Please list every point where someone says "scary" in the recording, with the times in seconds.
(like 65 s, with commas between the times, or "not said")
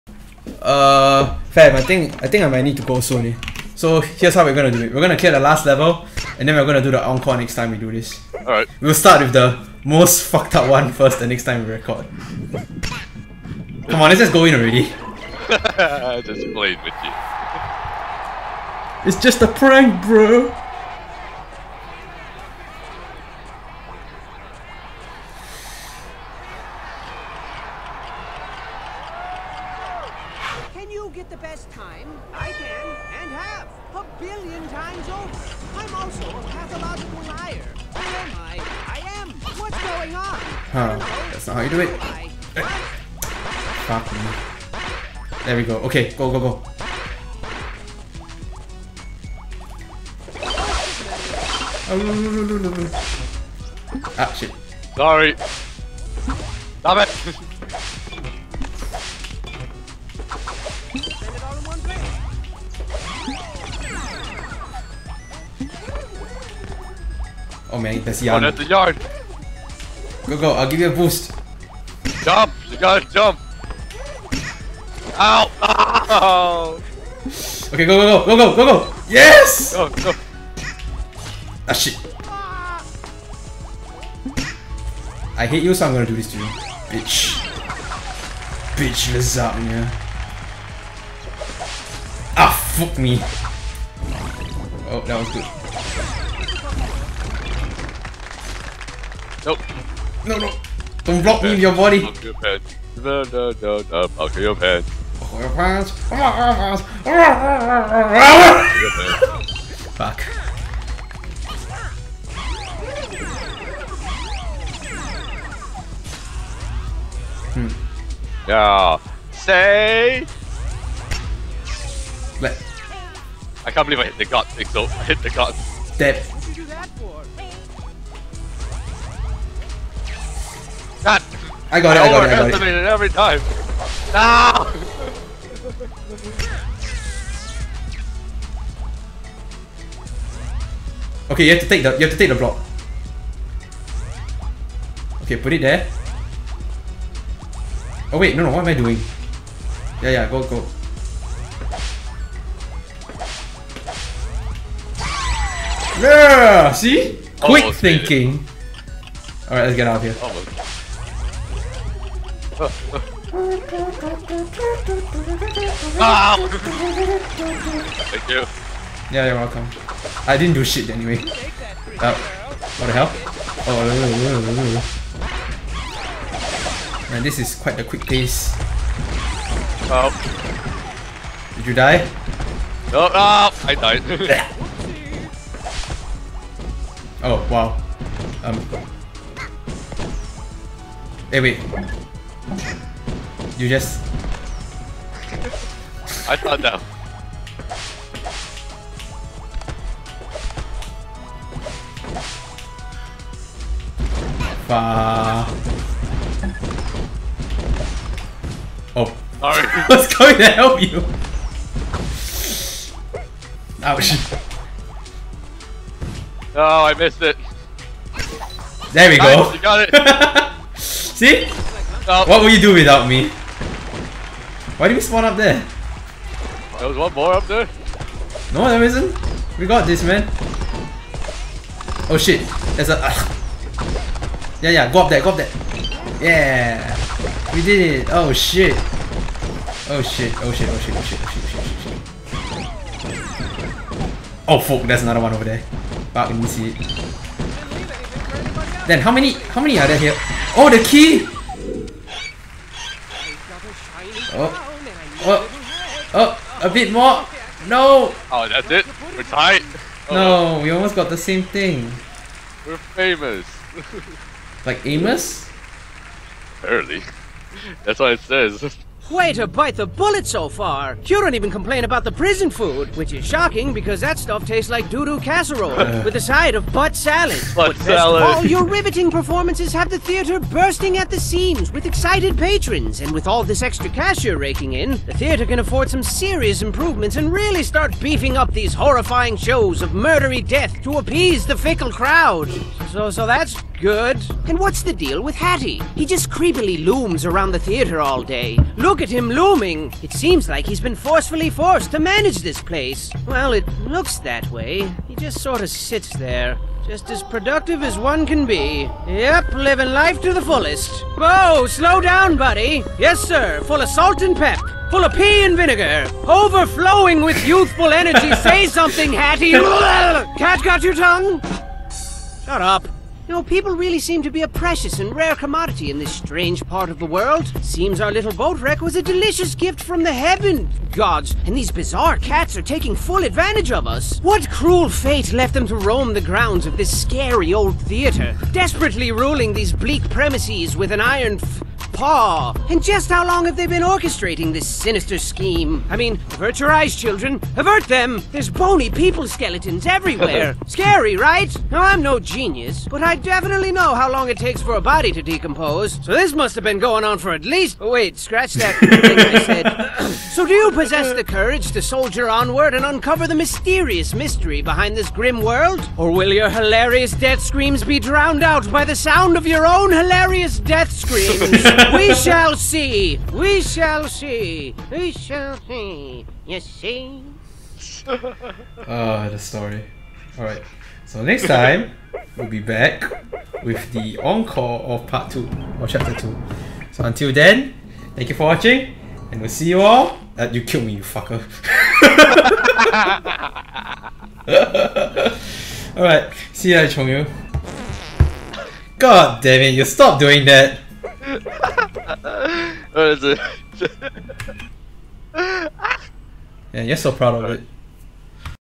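336 s, 350 s.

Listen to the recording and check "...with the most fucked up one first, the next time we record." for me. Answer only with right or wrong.
right.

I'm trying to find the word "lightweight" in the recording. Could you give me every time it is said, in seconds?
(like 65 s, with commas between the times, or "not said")
not said.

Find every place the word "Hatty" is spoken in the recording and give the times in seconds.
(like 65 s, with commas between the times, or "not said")
295 s, 319 s.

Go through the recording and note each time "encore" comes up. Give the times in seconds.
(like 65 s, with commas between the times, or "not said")
7 s, 384 s.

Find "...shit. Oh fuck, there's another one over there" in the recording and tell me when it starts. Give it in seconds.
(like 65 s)
242 s.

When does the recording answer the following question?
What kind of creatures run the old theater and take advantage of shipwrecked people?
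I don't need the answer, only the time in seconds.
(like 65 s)
332 s.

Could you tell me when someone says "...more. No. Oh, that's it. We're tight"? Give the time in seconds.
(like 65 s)
256 s.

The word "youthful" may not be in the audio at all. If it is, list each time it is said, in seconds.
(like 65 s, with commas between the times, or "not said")
317 s.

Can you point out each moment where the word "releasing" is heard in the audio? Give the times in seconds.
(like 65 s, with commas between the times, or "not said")
not said.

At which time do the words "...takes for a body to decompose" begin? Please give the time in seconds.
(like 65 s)
354 s.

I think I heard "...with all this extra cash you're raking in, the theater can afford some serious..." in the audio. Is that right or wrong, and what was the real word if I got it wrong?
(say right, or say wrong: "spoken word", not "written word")
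right.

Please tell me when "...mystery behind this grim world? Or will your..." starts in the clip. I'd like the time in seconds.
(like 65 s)
364 s.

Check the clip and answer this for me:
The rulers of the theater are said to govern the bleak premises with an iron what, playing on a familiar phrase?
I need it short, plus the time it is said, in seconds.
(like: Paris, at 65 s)
paw, at 341 s.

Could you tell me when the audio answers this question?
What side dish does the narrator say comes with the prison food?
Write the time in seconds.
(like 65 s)
276 s.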